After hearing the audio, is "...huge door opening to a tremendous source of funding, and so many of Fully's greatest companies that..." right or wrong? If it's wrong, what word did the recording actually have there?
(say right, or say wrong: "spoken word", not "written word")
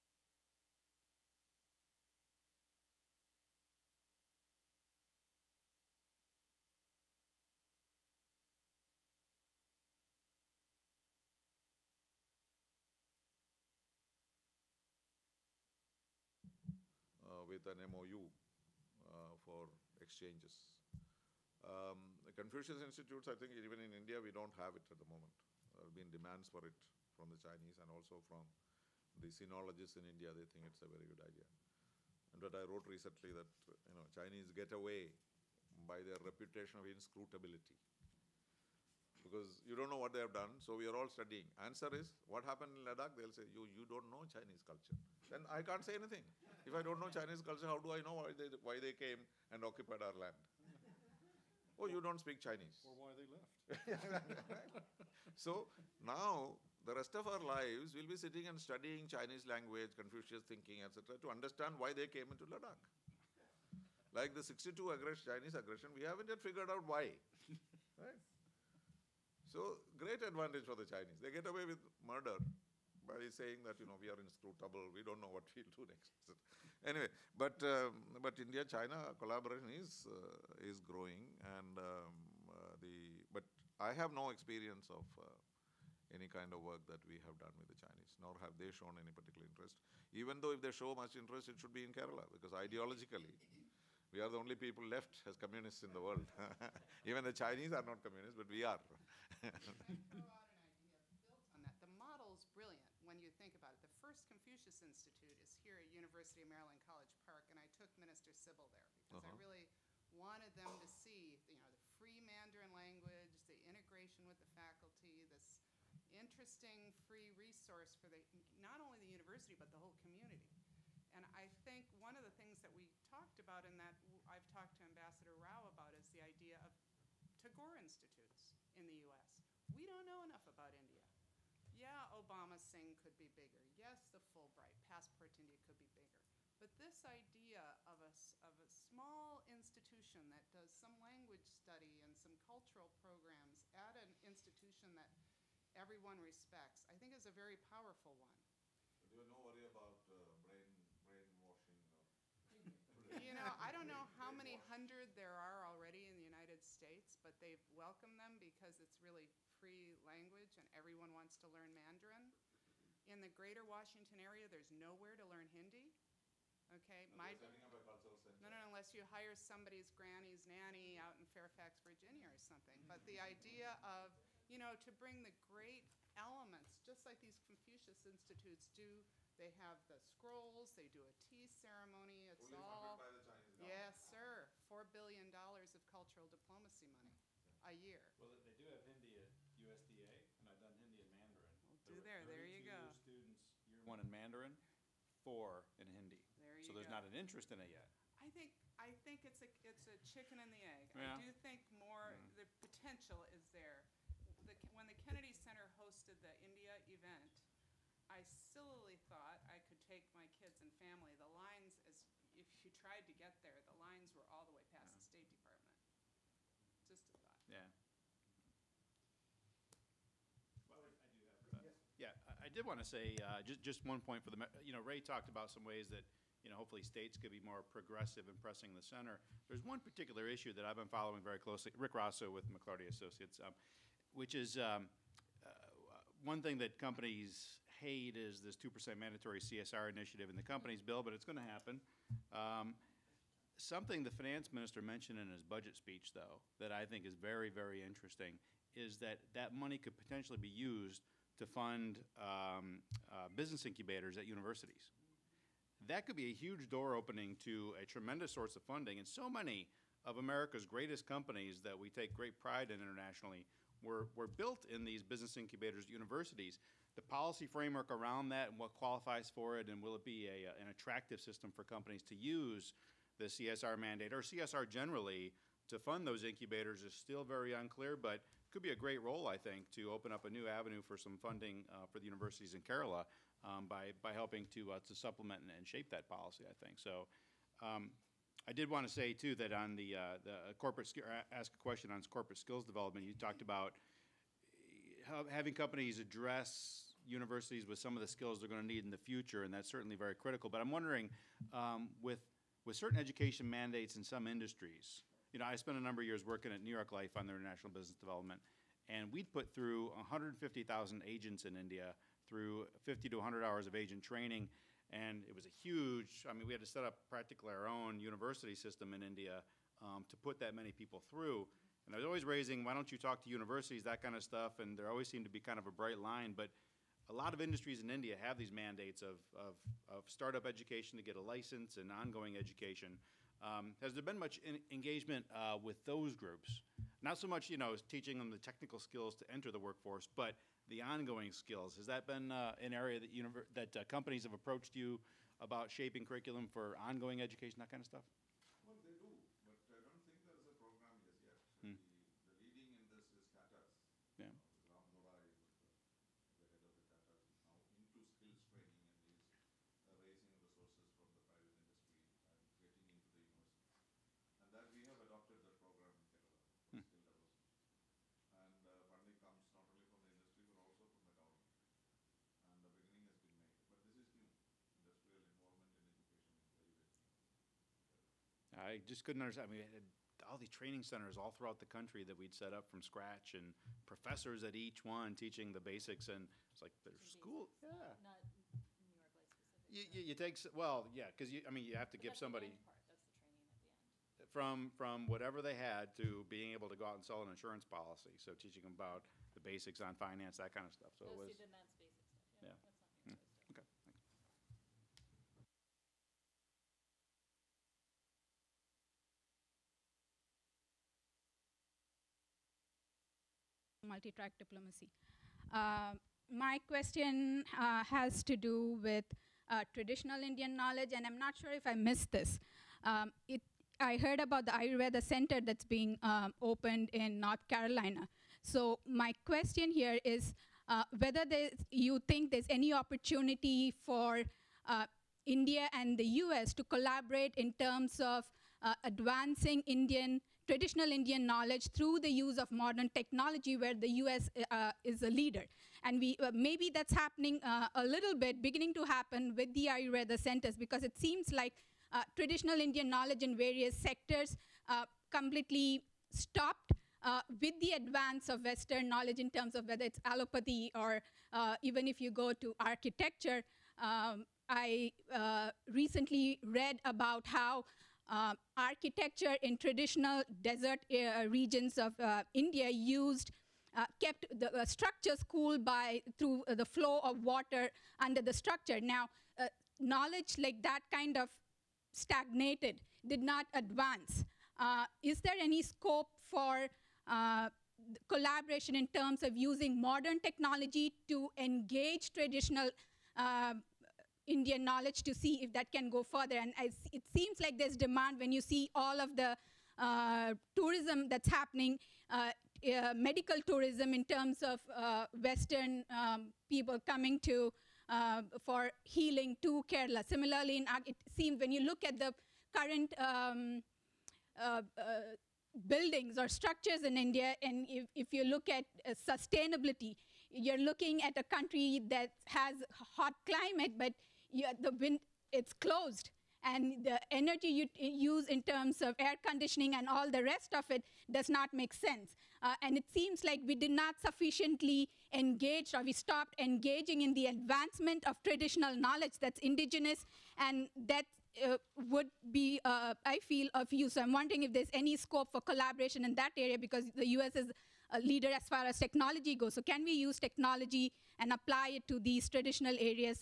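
wrong: "America", not "Fully".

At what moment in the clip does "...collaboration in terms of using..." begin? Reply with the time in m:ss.
8:08.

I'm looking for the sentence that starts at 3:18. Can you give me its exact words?
I think I think it's a it's a chicken and the egg.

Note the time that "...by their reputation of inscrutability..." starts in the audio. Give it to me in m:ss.
0:35.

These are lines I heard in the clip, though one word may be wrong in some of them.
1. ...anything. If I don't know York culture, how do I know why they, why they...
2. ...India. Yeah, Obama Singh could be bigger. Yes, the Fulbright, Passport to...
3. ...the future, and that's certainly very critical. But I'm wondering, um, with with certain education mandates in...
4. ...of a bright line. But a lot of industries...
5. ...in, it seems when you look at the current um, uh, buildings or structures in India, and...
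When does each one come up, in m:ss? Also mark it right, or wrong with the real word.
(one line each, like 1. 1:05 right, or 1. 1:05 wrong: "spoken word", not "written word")
1. 0:45 wrong: "Chinese", not "York"
2. 2:10 right
3. 4:58 right
4. 5:25 right
5. 8:30 right.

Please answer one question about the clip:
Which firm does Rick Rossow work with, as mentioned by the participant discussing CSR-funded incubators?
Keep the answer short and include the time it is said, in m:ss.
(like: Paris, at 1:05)
McLarty Associates, at 3:52.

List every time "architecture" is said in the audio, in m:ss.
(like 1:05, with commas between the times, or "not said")
7:42, 7:48.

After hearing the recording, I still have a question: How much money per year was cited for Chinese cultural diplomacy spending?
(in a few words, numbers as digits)
4 billion dollars.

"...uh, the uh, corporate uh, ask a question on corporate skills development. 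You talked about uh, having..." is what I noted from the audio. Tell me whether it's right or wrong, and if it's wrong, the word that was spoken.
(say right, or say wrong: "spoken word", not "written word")
right.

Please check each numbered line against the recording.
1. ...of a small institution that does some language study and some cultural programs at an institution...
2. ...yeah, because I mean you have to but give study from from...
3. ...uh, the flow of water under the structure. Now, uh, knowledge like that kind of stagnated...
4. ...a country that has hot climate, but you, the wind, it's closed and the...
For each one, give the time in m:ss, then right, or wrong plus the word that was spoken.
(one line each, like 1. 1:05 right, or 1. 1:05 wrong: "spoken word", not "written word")
1. 2:18 right
2. 6:30 wrong: "somebody", not "study"
3. 7:56 right
4. 8:41 right.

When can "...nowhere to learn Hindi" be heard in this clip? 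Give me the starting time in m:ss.
2:44.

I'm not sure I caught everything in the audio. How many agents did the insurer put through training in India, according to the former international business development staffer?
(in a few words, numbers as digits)
150,000.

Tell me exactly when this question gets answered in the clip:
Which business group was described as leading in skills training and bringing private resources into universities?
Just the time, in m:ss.
5:53.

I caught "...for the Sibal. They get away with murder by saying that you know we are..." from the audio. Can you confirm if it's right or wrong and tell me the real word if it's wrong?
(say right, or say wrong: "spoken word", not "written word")
wrong: "Chinese", not "Sibal".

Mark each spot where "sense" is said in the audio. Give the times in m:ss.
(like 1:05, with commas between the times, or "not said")
8:51.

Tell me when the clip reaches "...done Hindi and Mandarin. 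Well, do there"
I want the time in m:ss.
3:10.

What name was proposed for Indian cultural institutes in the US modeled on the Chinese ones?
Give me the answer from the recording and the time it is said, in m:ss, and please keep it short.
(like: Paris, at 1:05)
Tagore Institutes, at 2:07.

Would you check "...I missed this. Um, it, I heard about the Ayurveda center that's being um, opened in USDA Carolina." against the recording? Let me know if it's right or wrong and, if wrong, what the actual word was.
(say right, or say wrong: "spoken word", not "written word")
wrong: "North", not "USDA".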